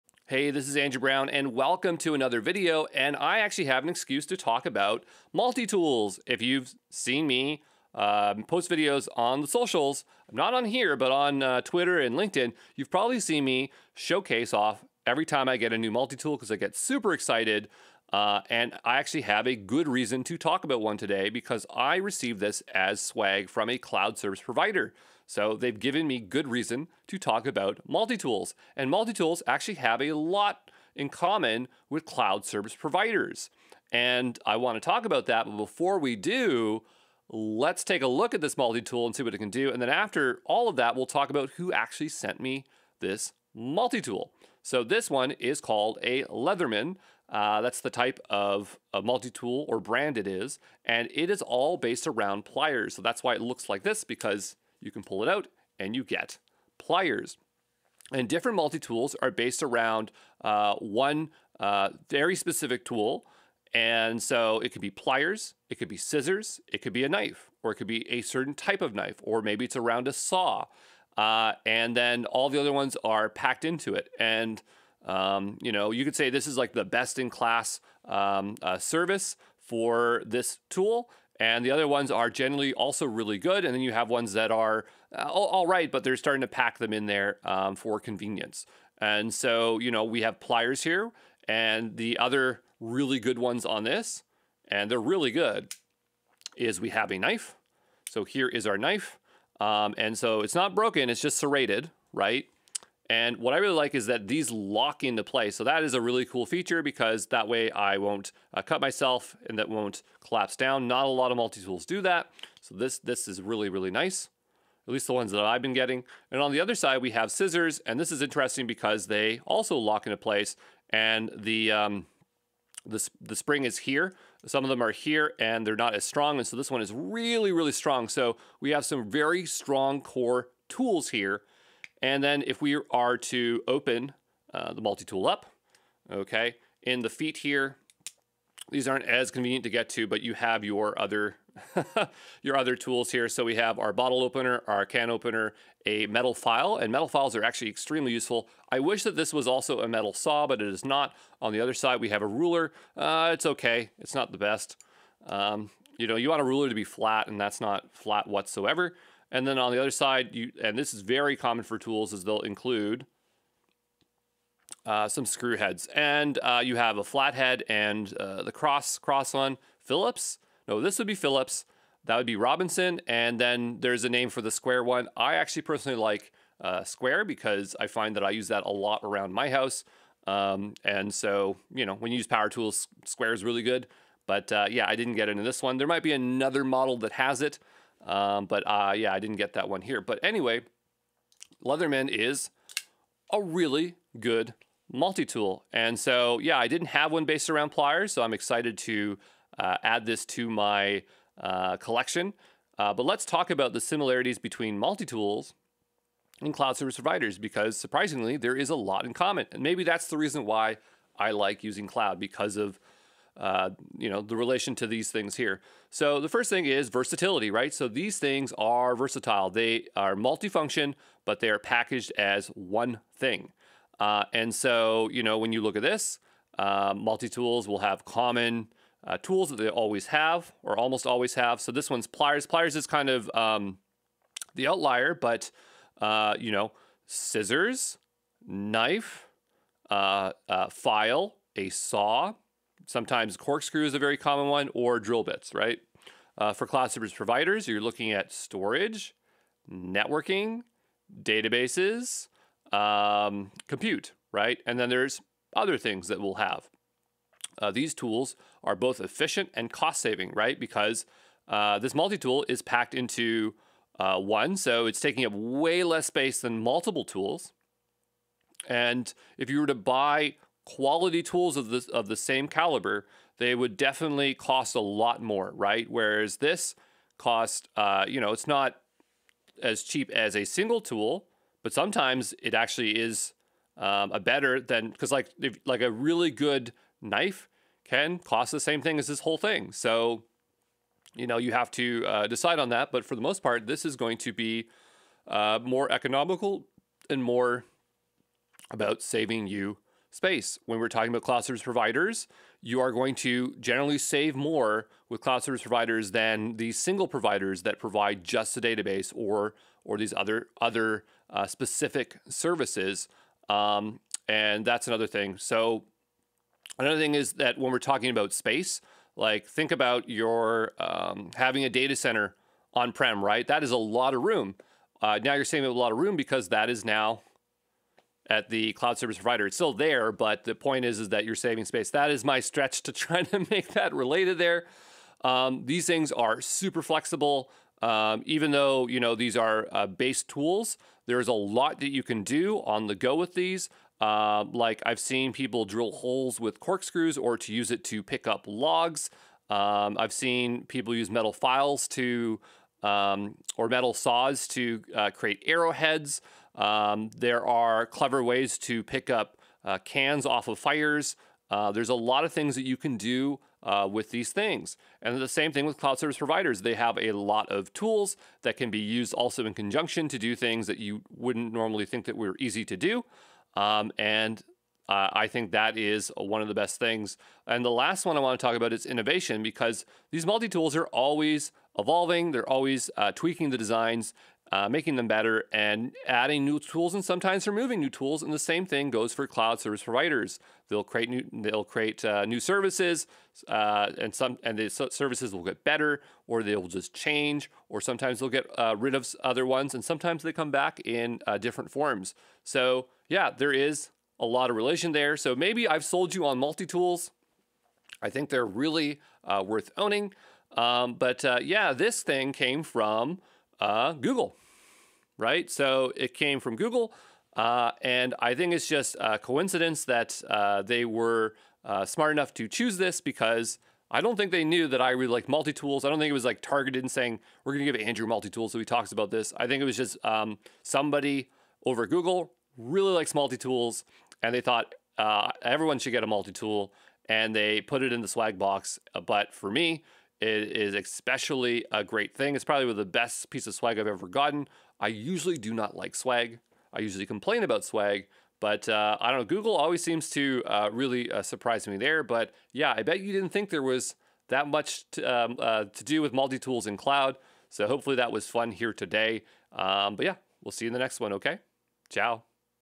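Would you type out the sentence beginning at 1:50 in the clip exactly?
Not a lot of multi-tools do that.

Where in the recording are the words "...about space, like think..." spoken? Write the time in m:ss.
5:18.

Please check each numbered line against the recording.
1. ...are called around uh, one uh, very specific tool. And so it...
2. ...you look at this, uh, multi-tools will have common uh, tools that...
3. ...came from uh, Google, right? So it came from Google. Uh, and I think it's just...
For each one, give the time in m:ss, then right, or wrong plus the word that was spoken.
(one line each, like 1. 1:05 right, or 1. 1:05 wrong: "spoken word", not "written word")
1. 0:59 wrong: "based", not "called"
2. 3:45 right
3. 6:52 right.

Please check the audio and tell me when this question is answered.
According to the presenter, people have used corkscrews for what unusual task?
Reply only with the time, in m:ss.
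5:45.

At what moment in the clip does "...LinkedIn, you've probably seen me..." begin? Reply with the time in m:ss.
0:12.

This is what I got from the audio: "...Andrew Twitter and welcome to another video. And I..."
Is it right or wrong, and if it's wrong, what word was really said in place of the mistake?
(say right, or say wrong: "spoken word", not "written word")
wrong: "Brown", not "Twitter".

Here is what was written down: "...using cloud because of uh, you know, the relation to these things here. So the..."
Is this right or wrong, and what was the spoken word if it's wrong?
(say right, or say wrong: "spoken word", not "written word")
right.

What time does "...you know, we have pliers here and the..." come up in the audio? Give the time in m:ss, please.
1:29.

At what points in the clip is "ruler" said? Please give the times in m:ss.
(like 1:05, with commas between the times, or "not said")
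2:32, 2:36.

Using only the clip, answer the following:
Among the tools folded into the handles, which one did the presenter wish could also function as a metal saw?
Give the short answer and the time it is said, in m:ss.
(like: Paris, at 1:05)
Metal file, at 2:26.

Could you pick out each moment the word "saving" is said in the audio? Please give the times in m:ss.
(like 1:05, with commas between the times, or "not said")
4:20, 4:59, 5:25, 5:31.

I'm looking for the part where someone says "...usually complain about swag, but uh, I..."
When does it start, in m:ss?
7:26.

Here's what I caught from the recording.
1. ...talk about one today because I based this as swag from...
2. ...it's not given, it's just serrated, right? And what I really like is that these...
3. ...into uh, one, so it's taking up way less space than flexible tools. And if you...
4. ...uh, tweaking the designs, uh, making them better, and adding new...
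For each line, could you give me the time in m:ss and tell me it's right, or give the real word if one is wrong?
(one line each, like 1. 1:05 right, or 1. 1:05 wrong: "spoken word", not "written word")
1. 0:20 wrong: "received", not "based"
2. 1:40 wrong: "broken", not "given"
3. 4:22 wrong: "multiple", not "flexible"
4. 6:22 right.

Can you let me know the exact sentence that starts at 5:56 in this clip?
Um, there are clever ways to pick up uh, cans off of fires.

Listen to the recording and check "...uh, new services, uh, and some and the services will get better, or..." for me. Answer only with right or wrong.
right.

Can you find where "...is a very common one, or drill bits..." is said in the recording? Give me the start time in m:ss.
4:03.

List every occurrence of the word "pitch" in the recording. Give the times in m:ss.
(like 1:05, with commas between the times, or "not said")
not said.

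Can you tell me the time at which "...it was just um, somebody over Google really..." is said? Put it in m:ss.
7:09.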